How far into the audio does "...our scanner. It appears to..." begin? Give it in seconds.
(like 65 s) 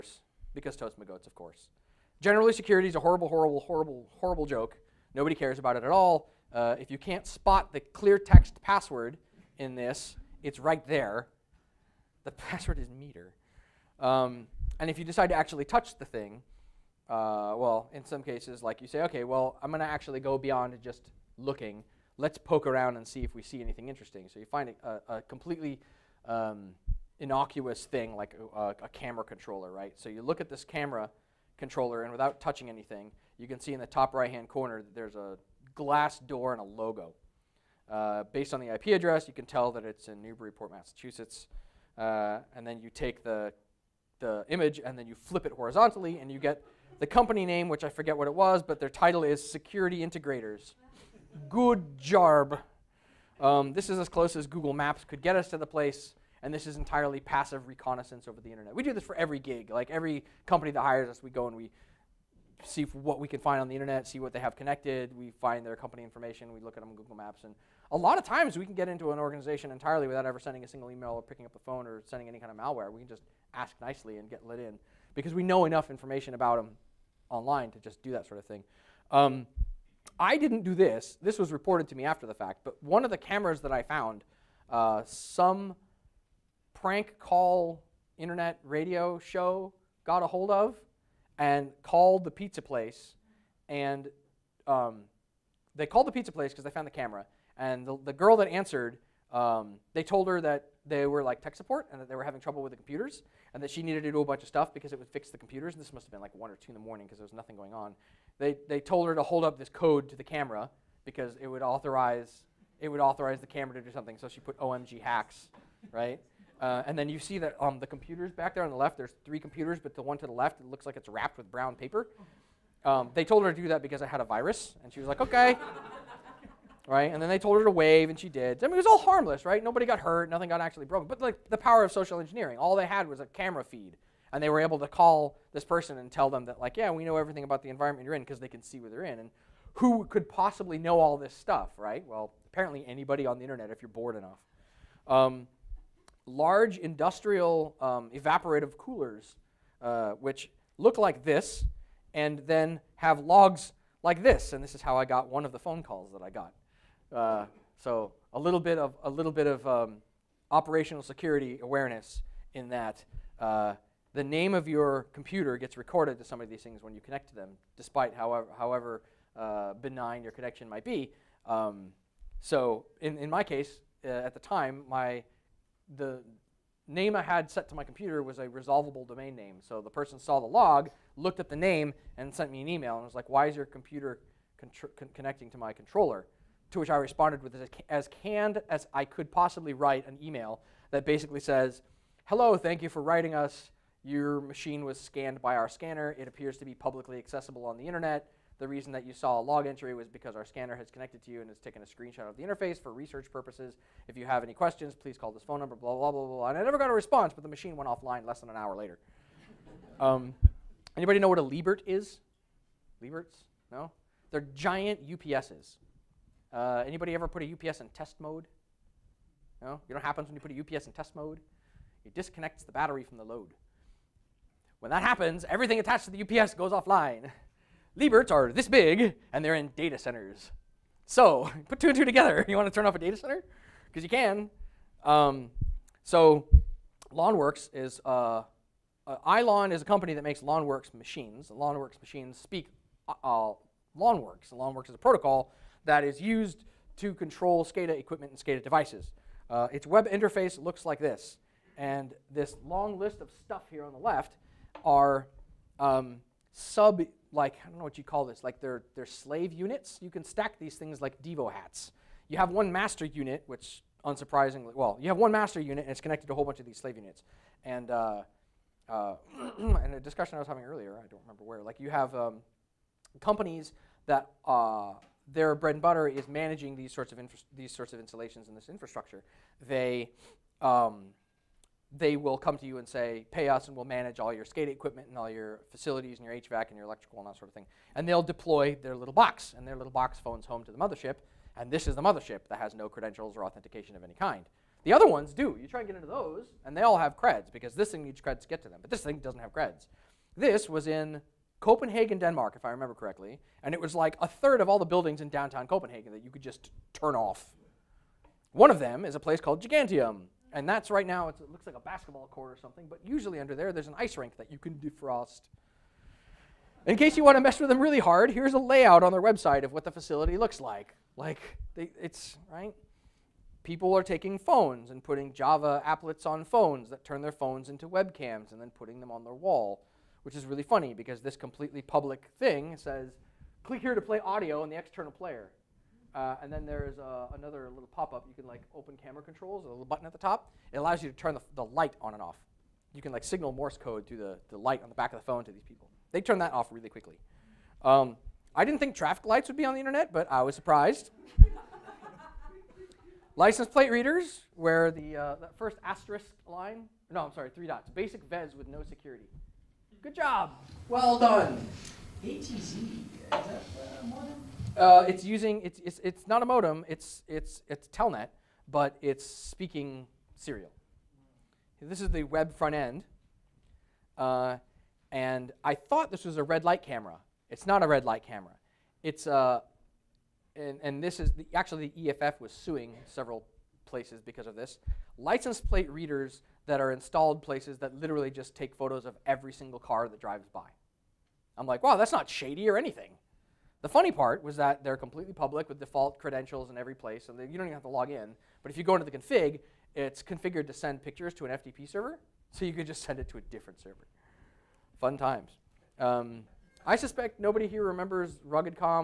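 195 s.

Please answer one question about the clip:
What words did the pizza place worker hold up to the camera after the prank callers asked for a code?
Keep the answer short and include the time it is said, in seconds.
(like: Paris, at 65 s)
OMG hacks, at 114 s.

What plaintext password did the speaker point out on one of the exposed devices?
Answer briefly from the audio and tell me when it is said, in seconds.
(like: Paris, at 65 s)
meter, at 12 s.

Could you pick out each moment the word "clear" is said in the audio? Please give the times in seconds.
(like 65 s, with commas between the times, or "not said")
7 s.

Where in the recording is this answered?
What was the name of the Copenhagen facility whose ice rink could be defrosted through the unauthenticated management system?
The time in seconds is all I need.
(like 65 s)
309 s.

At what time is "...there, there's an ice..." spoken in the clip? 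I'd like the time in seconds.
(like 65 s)
313 s.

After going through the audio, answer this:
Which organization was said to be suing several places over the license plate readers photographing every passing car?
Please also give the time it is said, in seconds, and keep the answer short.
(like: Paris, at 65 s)
EFF, at 381 s.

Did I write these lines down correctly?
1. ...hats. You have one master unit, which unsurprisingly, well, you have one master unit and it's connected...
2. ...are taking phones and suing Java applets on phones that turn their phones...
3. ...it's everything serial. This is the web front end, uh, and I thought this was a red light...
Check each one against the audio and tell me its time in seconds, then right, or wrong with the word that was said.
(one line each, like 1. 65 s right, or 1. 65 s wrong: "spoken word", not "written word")
1. 261 s right
2. 323 s wrong: "putting", not "suing"
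3. 369 s wrong: "speaking", not "everything".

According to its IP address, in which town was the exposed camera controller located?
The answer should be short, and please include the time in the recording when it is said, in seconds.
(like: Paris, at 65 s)
Newburyport, Massachusetts, at 40 s.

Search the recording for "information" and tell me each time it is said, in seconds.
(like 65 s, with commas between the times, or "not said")
66 s, 75 s.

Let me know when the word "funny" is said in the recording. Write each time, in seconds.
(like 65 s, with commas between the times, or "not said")
330 s, 393 s.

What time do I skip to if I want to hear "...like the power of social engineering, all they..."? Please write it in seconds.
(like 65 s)
131 s.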